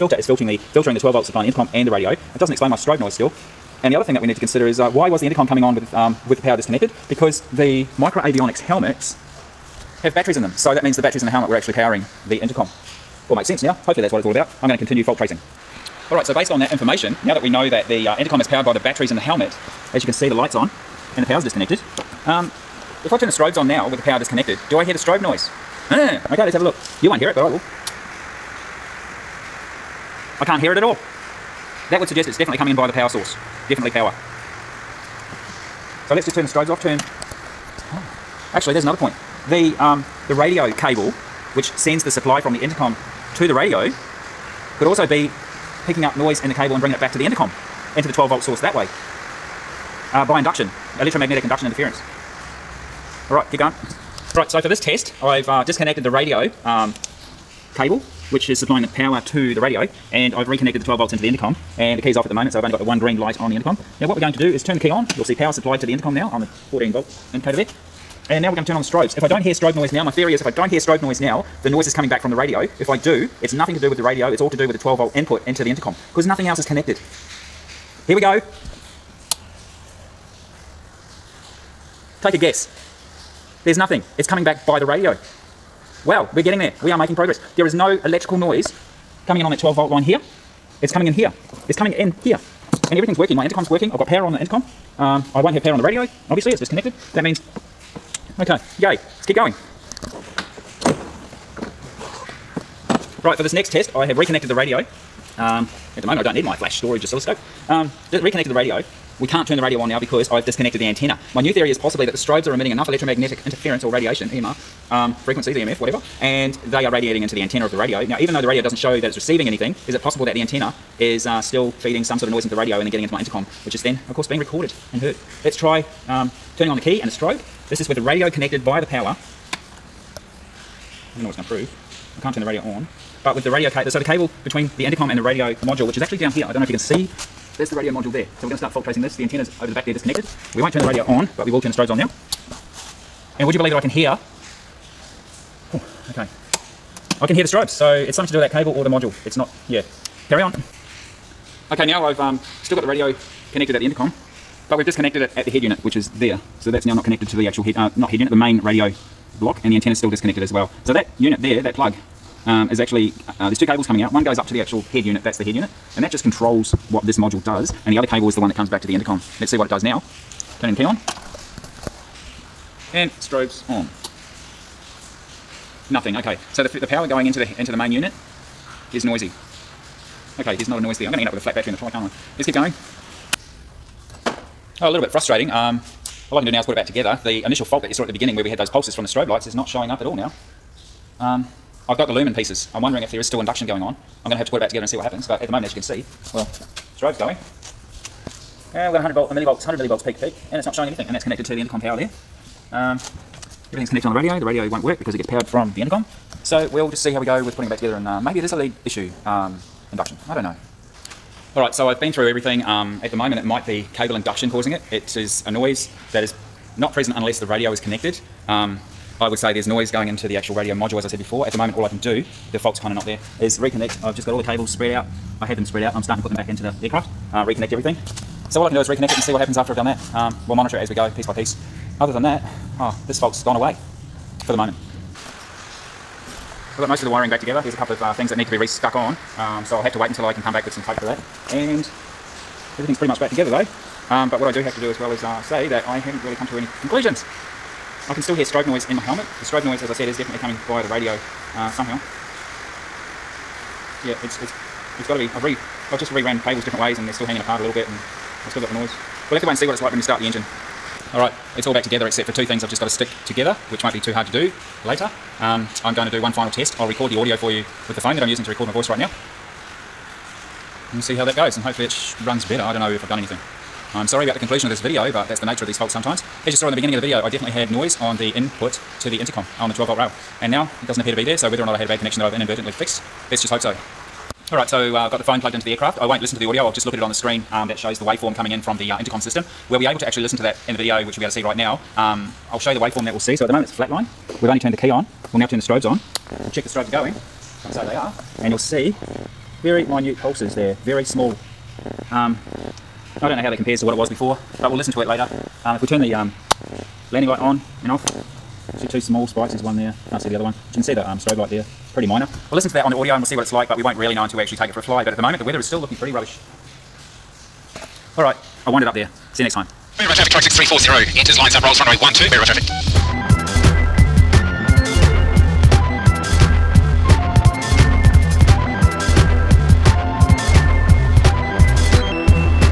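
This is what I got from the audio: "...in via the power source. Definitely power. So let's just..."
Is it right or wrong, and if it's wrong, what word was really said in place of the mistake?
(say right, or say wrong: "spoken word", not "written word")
right.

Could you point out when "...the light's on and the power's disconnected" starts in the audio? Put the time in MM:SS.
00:20.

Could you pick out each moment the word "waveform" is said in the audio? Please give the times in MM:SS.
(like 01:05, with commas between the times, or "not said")
04:48, 04:52.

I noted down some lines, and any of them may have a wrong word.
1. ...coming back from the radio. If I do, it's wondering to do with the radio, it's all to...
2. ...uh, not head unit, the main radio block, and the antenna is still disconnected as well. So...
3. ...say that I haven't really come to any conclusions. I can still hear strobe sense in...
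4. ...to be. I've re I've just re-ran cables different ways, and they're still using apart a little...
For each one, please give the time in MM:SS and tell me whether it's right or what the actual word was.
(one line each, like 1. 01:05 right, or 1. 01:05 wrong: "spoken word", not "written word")
1. 01:11 wrong: "nothing", not "wondering"
2. 02:37 right
3. 04:05 wrong: "noise", not "sense"
4. 04:15 wrong: "hanging", not "using".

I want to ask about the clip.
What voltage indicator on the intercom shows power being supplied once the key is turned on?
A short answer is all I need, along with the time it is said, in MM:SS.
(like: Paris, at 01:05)
14 volt, at 01:06.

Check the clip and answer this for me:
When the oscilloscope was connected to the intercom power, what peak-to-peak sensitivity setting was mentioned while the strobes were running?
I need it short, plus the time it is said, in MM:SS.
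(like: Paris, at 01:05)
100 millivolts, at 03:19.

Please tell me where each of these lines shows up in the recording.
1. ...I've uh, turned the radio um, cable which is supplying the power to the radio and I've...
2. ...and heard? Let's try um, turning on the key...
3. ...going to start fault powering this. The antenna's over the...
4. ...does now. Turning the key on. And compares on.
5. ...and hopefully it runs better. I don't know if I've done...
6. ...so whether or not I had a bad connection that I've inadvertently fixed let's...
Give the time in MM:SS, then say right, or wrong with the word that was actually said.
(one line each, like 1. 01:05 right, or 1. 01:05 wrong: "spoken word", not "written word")
1. 00:55 wrong: "disconnected", not "turned"
2. 02:04 right
3. 02:18 wrong: "tracing", not "powering"
4. 02:49 wrong: "strobes", not "compares"
5. 04:31 right
6. 04:41 right.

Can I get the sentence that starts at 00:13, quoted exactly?
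Hopefully that's what it's all about.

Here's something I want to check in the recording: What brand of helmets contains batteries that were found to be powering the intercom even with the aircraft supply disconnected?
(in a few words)
Micro Avionics.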